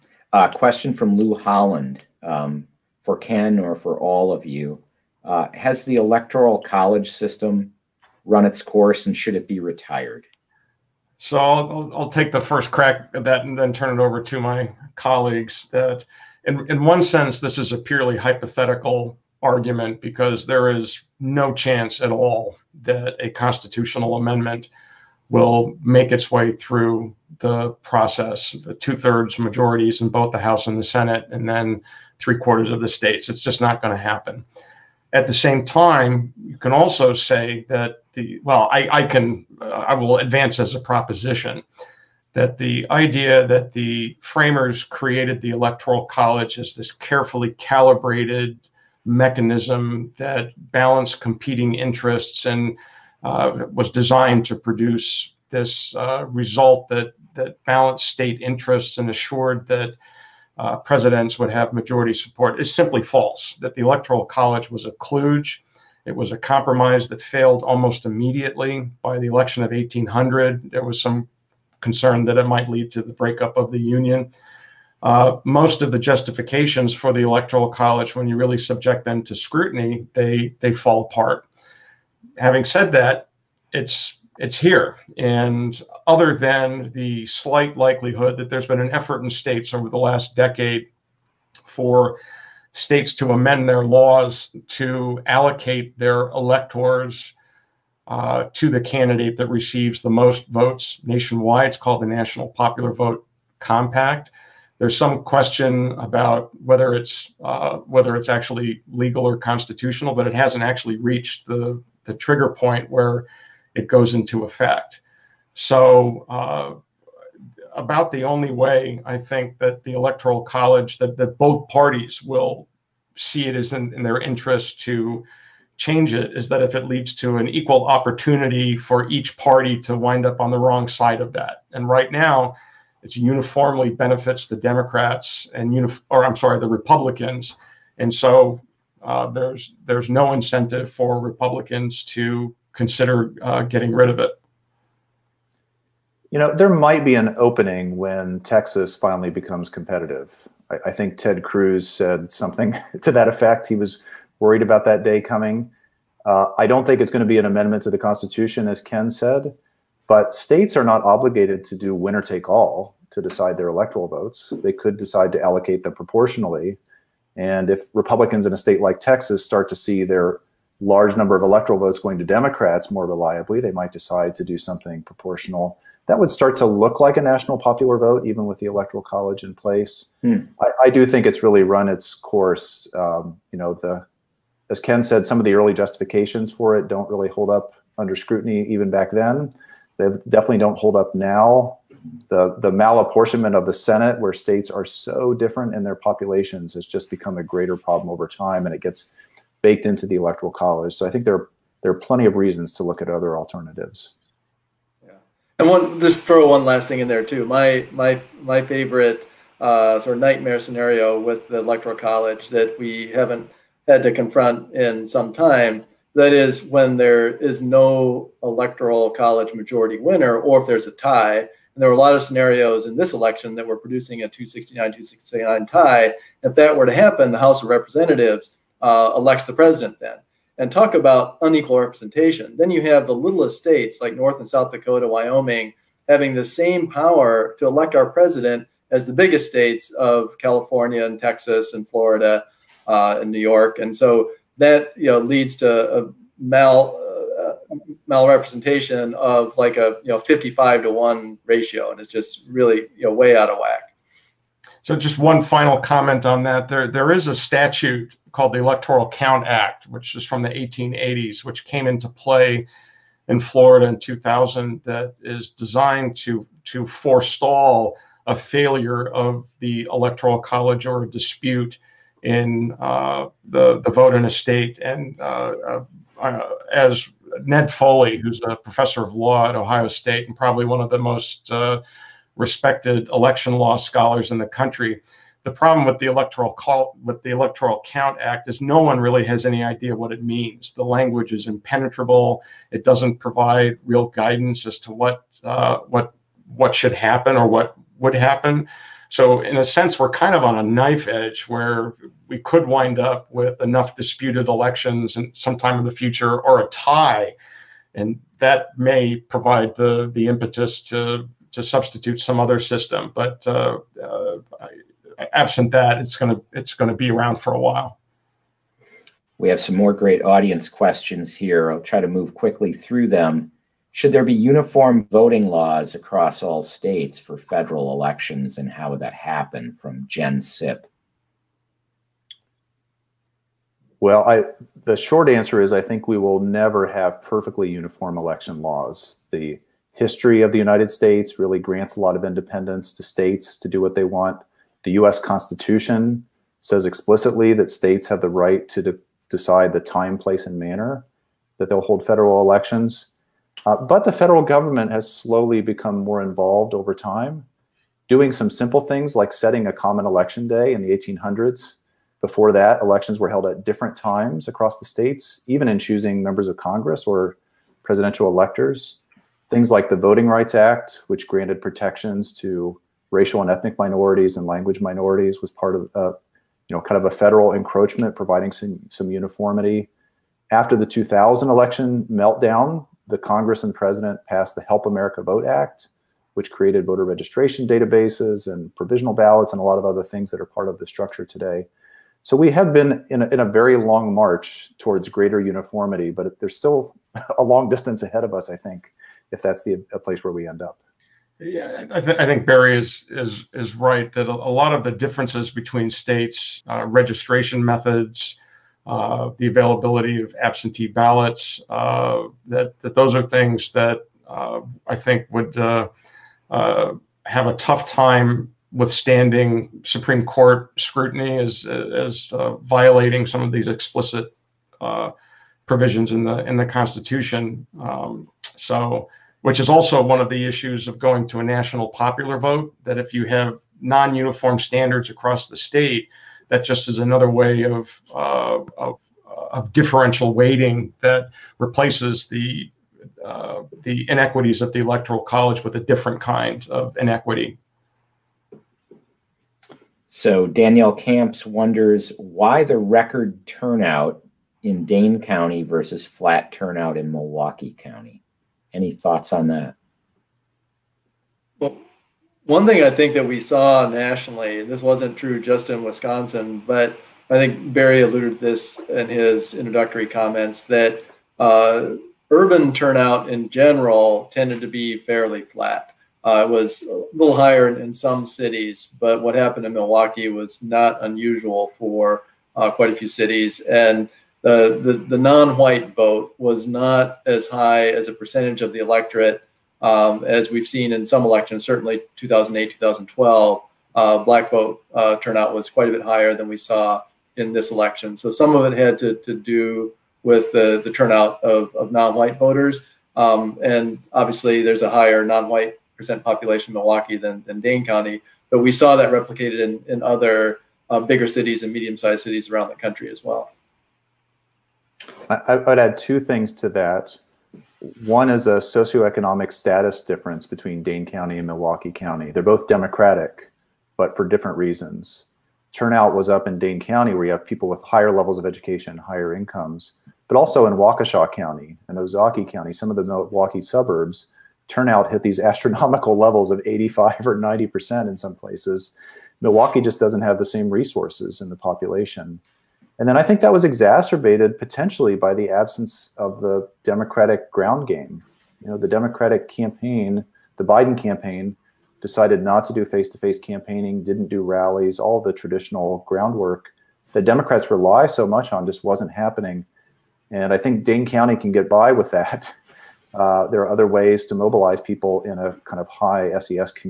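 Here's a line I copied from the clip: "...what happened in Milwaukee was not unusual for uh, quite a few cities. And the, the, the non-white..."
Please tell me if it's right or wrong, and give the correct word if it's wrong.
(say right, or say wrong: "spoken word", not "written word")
right.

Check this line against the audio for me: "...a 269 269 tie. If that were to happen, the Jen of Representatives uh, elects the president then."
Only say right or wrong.
wrong.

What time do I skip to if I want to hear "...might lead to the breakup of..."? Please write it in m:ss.
1:12.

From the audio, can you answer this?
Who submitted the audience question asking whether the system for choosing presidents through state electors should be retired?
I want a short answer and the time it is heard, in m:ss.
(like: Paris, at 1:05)
Lou Holland, at 0:01.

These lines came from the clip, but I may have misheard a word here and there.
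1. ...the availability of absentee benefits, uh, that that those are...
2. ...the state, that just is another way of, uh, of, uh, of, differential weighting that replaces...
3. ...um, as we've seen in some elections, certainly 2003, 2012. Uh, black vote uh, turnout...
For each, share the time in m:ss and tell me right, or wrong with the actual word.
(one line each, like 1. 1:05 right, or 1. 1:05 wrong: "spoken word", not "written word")
1. 6:49 wrong: "ballots", not "benefits"
2. 7:15 right
3. 8:09 wrong: "2008", not "2003".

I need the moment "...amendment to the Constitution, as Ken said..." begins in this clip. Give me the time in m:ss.
2:37.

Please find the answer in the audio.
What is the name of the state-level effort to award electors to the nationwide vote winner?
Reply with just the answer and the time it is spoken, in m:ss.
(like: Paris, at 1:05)
National Popular Vote Compact, at 1:42.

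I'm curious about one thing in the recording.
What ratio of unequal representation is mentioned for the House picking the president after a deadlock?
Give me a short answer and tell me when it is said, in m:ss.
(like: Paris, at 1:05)
55 to 1, at 4:10.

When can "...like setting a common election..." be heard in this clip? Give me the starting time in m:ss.
5:59.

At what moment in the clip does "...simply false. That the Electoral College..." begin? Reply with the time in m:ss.
1:02.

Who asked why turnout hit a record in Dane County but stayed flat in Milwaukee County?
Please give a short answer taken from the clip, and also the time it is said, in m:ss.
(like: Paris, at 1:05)
Danielle Camps, at 7:30.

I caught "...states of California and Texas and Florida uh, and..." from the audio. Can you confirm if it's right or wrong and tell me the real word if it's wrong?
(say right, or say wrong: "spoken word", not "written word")
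right.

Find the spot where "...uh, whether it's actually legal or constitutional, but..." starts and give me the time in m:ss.
1:47.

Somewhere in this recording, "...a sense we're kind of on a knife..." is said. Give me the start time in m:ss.
4:59.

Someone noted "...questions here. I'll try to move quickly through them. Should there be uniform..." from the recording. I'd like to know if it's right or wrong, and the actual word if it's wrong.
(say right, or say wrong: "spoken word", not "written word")
right.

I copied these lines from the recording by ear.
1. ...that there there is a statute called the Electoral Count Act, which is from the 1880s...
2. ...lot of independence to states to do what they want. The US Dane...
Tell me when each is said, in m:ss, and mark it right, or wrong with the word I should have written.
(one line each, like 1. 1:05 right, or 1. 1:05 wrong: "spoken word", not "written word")
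1. 4:16 right
2. 5:41 wrong: "Constitution", not "Dane".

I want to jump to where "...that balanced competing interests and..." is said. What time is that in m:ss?
0:50.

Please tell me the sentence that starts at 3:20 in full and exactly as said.
So I think there there are plenty of reasons to look at other alternatives.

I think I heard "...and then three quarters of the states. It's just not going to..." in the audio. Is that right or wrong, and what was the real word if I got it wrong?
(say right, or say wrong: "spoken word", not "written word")
right.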